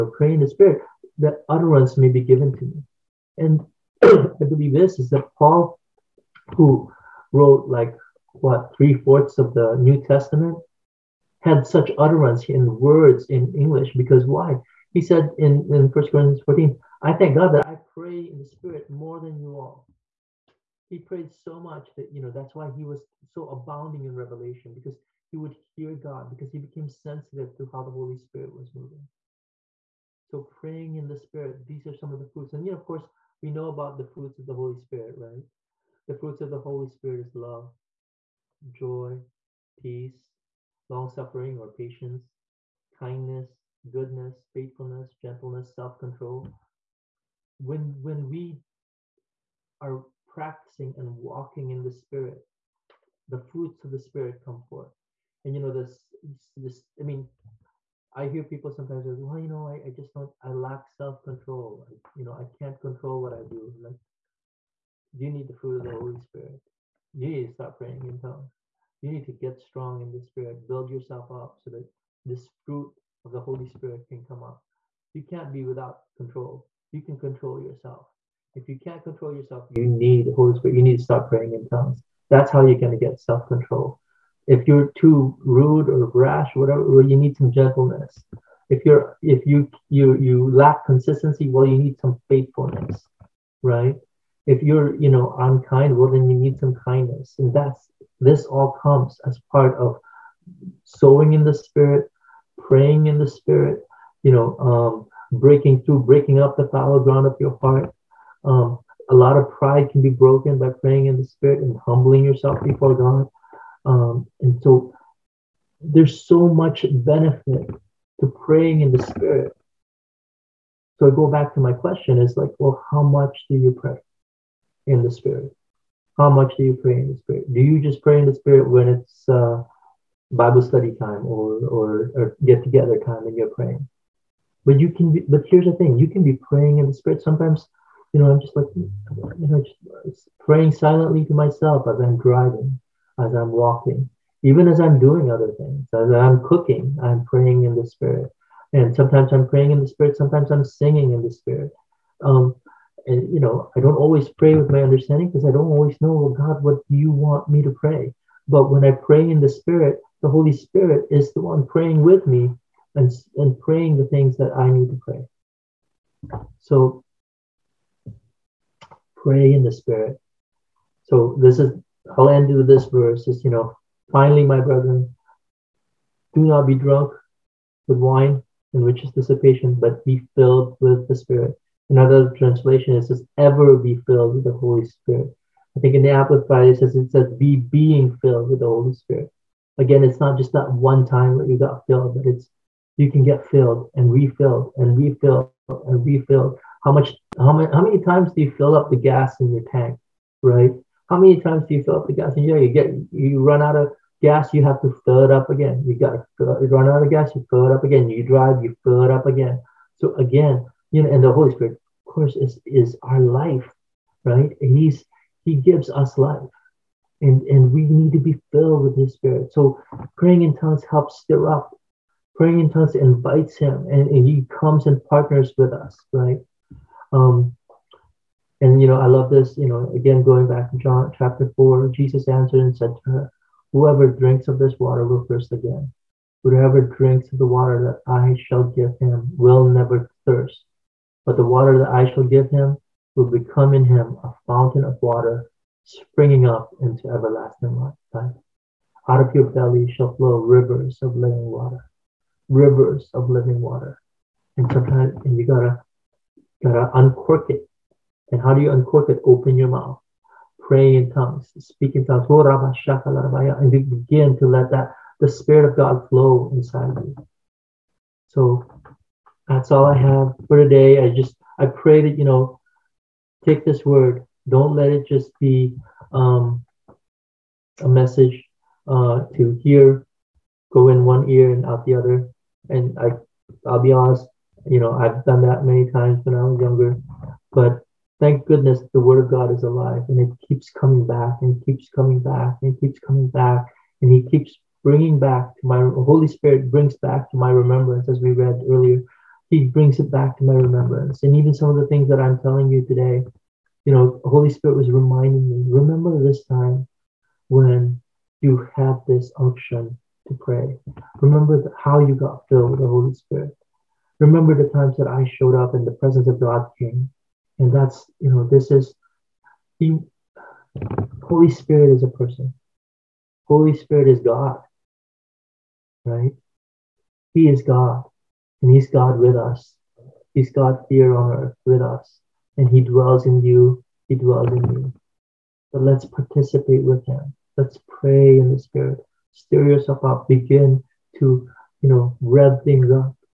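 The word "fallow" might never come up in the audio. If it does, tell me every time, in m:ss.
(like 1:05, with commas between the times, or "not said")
1:46.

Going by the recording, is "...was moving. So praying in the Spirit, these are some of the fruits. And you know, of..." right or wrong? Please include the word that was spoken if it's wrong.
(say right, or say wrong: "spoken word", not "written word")
right.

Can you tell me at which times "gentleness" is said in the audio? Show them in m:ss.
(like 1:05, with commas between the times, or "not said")
0:45, 1:27.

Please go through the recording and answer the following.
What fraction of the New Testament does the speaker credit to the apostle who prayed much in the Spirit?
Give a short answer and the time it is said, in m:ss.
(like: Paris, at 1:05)
three fourths, at 0:08.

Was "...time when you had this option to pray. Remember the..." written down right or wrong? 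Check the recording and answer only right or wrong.
right.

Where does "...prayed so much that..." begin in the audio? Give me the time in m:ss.
0:20.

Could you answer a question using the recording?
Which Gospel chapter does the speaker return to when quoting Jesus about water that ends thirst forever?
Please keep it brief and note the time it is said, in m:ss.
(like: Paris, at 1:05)
John chapter 4, at 3:50.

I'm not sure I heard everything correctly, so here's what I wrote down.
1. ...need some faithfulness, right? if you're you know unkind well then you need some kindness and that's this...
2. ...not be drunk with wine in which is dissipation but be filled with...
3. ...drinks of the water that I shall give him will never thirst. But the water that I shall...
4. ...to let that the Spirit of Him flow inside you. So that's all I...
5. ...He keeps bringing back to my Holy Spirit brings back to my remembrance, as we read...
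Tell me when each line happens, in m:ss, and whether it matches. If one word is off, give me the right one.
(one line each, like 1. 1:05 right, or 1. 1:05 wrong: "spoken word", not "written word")
1. 1:31 right
2. 2:56 right
3. 3:56 right
4. 4:24 wrong: "God", not "Him"
5. 4:54 right.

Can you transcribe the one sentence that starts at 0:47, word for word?
When, when we are practicing and walking in the Spirit, the fruits of the Spirit come forth.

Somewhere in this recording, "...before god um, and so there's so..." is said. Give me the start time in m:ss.
1:52.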